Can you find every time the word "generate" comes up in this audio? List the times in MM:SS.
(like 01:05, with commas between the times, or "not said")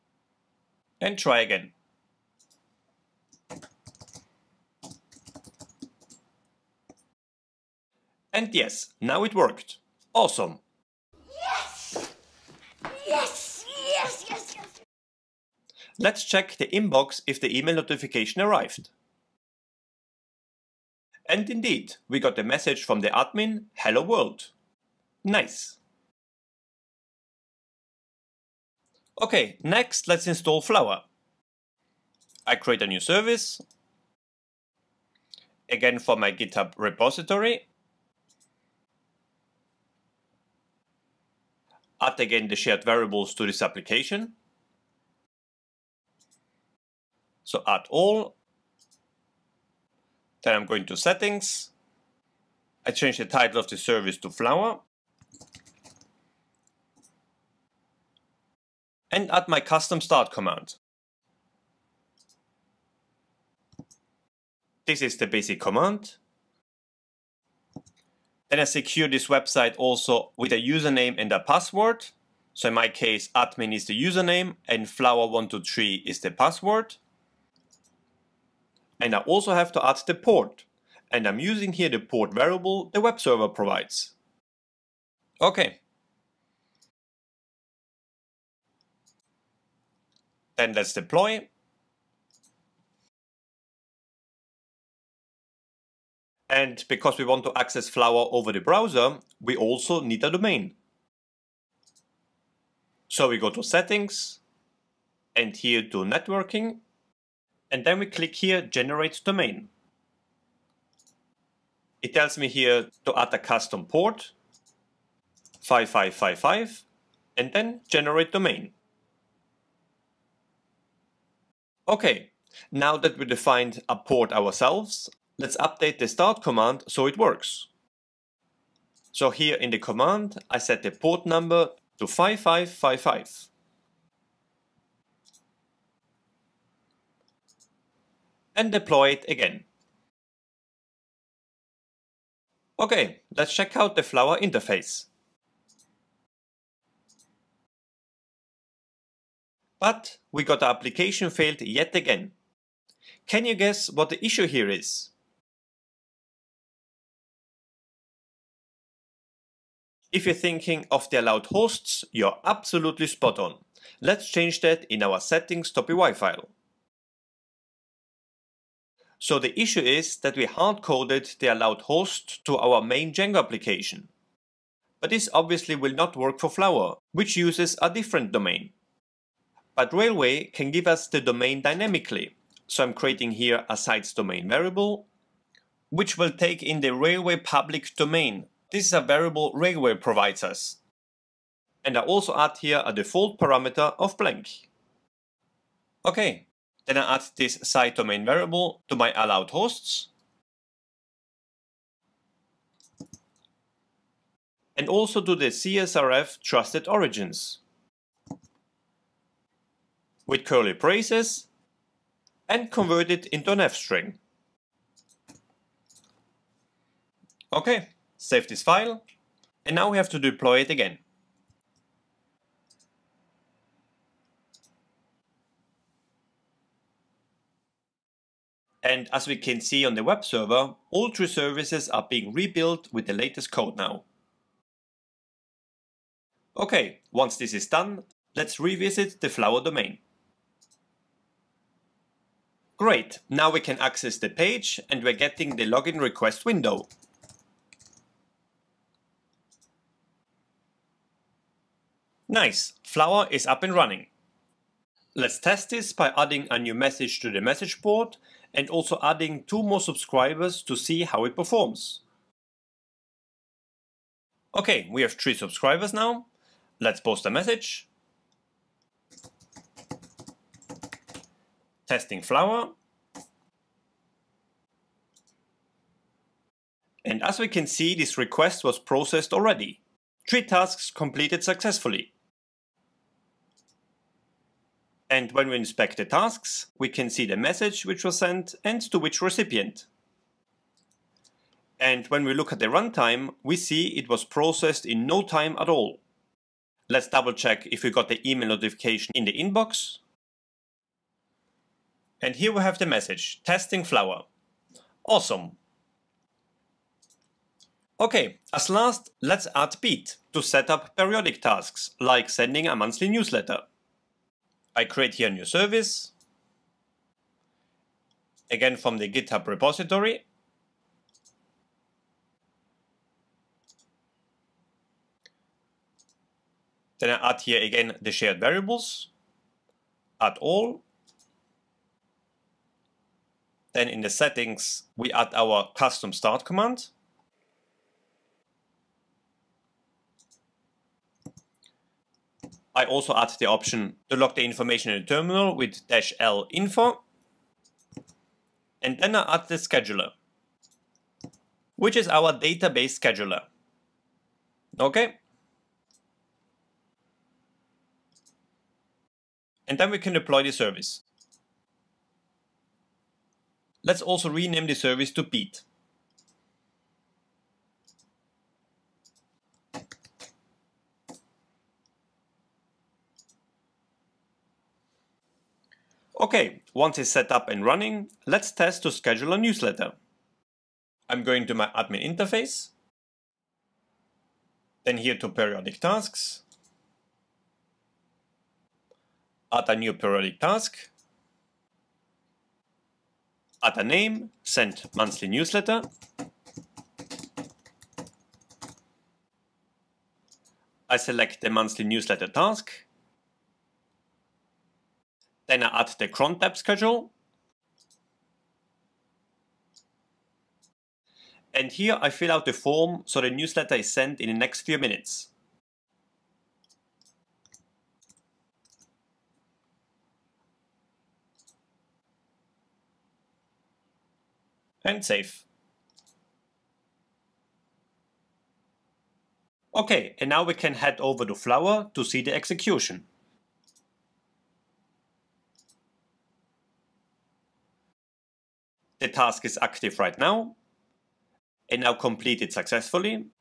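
01:48, 01:57.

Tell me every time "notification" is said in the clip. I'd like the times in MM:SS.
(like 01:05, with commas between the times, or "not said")
00:17, 04:58.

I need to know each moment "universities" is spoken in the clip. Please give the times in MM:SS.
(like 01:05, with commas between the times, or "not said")
not said.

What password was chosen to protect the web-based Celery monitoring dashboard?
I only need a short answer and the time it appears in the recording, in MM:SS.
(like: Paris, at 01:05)
flower123, at 01:14.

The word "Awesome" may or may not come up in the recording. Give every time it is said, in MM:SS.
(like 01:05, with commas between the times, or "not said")
00:10, 05:05.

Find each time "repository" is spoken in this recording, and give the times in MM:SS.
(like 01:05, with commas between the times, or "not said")
00:36, 05:19.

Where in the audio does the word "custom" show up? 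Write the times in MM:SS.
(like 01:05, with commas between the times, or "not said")
00:59, 01:53, 05:35.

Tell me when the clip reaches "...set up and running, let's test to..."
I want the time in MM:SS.
06:17.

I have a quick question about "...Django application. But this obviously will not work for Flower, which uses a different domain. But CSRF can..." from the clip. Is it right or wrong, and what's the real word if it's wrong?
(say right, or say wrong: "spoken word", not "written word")
wrong: "Railway", not "CSRF".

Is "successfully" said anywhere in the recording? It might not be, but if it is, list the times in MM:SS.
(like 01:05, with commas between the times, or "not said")
04:41, 07:22.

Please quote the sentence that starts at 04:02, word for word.
Great, now we can access the page and we're getting the login request window.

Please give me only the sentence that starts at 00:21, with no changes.
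And indeed, we got a message from the admin, hello world.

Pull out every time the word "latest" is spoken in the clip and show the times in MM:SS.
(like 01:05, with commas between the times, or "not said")
03:53.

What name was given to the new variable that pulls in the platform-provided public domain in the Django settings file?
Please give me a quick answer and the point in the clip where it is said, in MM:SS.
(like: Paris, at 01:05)
sites domain, at 03:03.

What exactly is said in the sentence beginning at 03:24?
And also to the CSRF trusted origins.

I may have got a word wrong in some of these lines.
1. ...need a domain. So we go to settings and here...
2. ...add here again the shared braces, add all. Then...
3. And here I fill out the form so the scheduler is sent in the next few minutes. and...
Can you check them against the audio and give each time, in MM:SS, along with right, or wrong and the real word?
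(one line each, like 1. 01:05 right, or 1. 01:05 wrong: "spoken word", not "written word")
1. 01:40 right
2. 05:27 wrong: "variables", not "braces"
3. 06:51 wrong: "newsletter", not "scheduler".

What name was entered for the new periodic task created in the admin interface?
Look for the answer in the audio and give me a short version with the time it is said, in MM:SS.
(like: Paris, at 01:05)
send monthly newsletter, at 06:34.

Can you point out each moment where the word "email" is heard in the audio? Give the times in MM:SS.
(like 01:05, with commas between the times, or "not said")
00:17, 04:58.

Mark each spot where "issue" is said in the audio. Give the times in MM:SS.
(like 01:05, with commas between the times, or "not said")
02:34, 02:49.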